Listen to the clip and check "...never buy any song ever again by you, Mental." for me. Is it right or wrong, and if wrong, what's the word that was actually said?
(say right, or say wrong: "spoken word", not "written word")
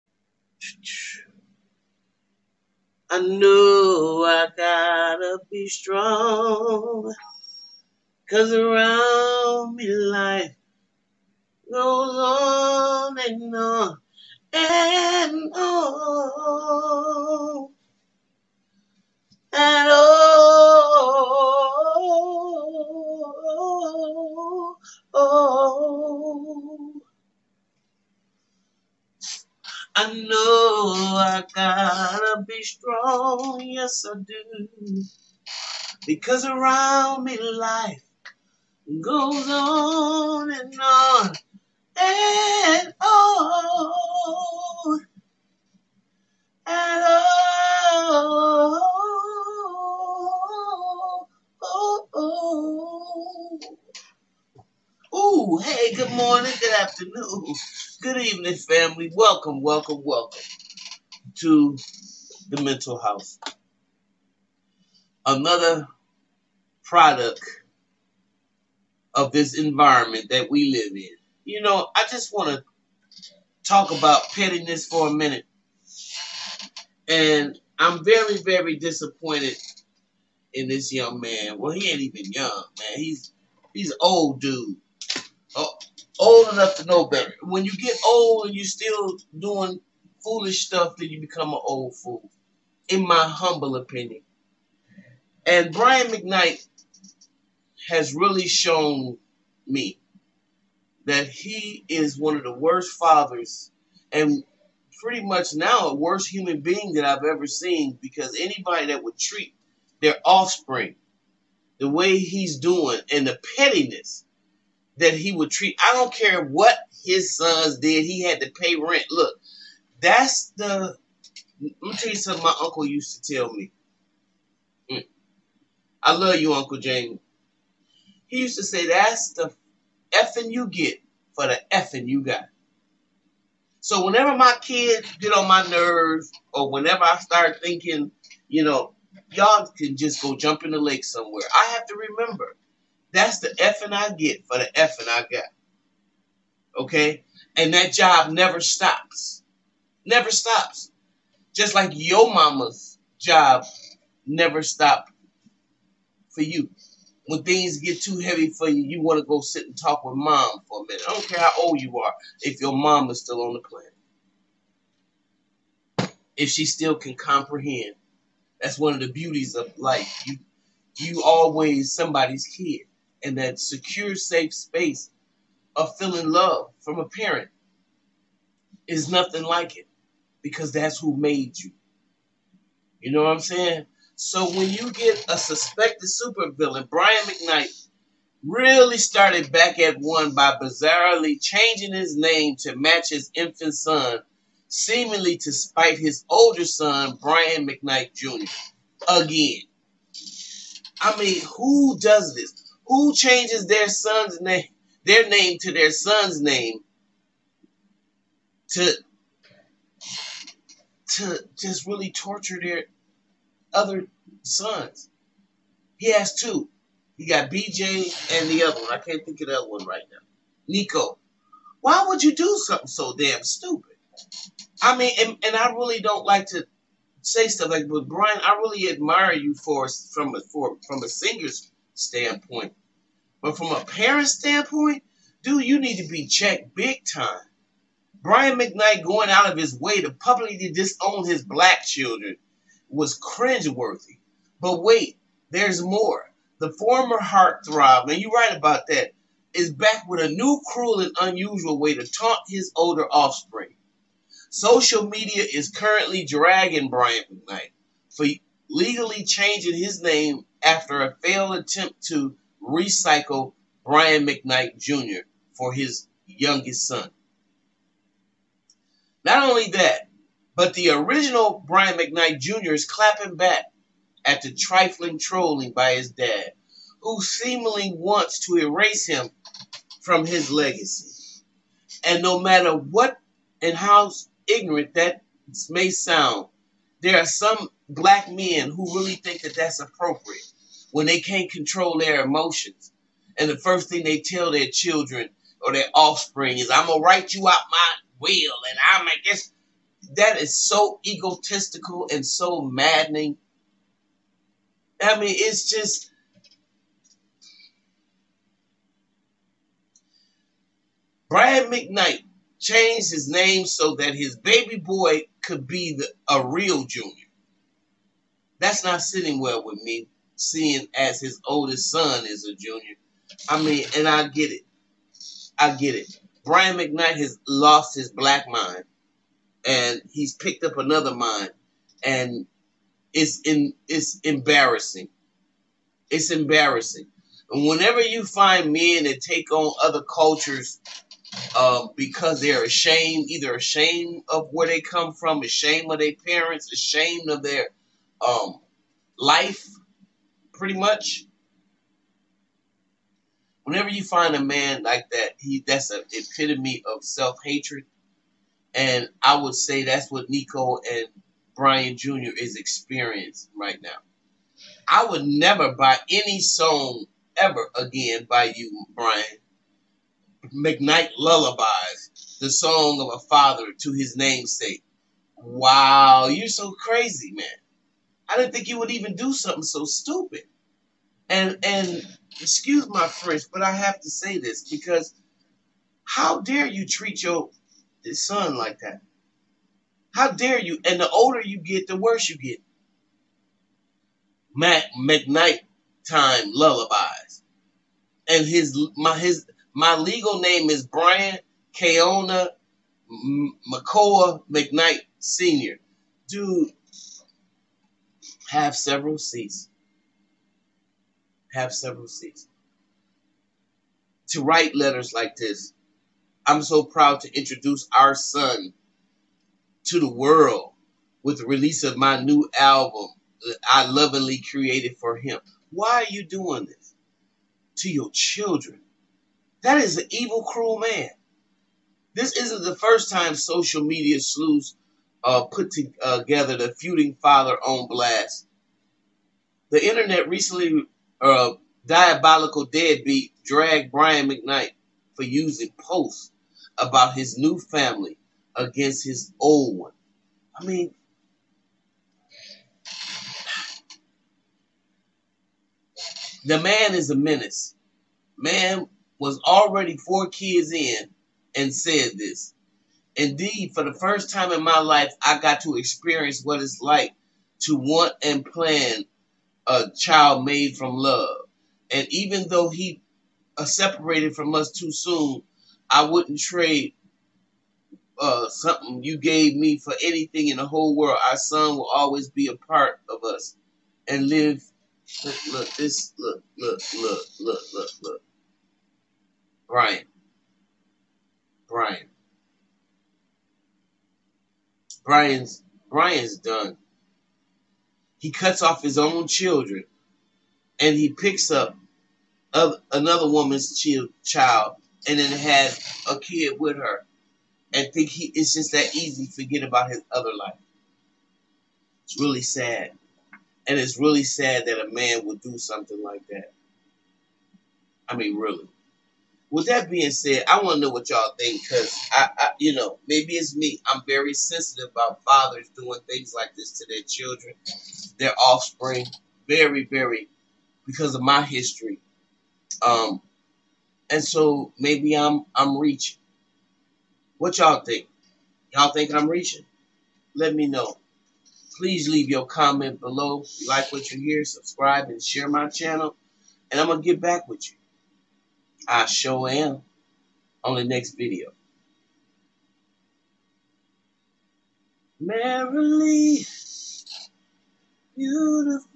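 wrong: "Brian", not "Mental".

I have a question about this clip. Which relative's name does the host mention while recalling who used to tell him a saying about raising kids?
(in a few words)
Uncle Jamie.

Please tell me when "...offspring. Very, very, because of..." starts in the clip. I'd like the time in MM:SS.
08:48.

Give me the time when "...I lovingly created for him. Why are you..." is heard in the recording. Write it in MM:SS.
07:03.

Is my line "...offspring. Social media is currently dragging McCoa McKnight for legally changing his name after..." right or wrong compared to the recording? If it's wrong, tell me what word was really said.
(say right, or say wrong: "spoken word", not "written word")
wrong: "Brian", not "McCoa".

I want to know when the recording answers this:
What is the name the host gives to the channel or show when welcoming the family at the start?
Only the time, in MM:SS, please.
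01:02.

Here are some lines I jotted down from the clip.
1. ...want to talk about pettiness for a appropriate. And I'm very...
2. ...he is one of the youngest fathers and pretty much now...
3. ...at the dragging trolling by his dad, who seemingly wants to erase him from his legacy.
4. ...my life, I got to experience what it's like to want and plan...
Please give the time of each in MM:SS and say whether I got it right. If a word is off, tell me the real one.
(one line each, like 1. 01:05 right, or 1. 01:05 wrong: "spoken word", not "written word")
1. 01:12 wrong: "minute", not "appropriate"
2. 01:41 wrong: "worst", not "youngest"
3. 04:34 wrong: "trifling", not "dragging"
4. 07:44 right.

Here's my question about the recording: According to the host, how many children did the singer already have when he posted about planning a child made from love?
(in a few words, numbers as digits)
4.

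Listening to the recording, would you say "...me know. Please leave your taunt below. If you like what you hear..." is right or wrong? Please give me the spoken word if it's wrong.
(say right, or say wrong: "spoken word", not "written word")
wrong: "comment", not "taunt".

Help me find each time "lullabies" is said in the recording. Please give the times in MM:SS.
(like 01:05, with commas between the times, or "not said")
06:11, 06:36.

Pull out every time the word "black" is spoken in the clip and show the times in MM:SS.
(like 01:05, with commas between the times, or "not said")
04:01, 04:47, 05:28.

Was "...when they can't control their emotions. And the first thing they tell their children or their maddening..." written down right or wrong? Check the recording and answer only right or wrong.
wrong.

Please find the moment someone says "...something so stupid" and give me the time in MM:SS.
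06:19.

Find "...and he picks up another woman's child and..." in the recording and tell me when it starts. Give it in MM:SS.
08:20.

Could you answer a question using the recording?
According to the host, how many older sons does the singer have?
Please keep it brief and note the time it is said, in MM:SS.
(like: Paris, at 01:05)
2, at 03:36.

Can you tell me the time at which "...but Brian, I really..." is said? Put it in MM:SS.
03:47.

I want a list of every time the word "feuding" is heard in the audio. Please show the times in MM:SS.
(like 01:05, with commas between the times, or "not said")
07:16.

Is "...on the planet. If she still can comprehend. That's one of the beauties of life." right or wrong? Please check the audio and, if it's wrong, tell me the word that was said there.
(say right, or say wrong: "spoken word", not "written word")
right.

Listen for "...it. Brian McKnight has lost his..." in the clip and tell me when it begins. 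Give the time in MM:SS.
05:25.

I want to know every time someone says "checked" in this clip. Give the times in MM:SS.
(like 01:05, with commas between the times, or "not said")
03:56.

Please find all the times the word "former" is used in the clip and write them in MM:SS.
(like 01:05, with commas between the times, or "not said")
04:06.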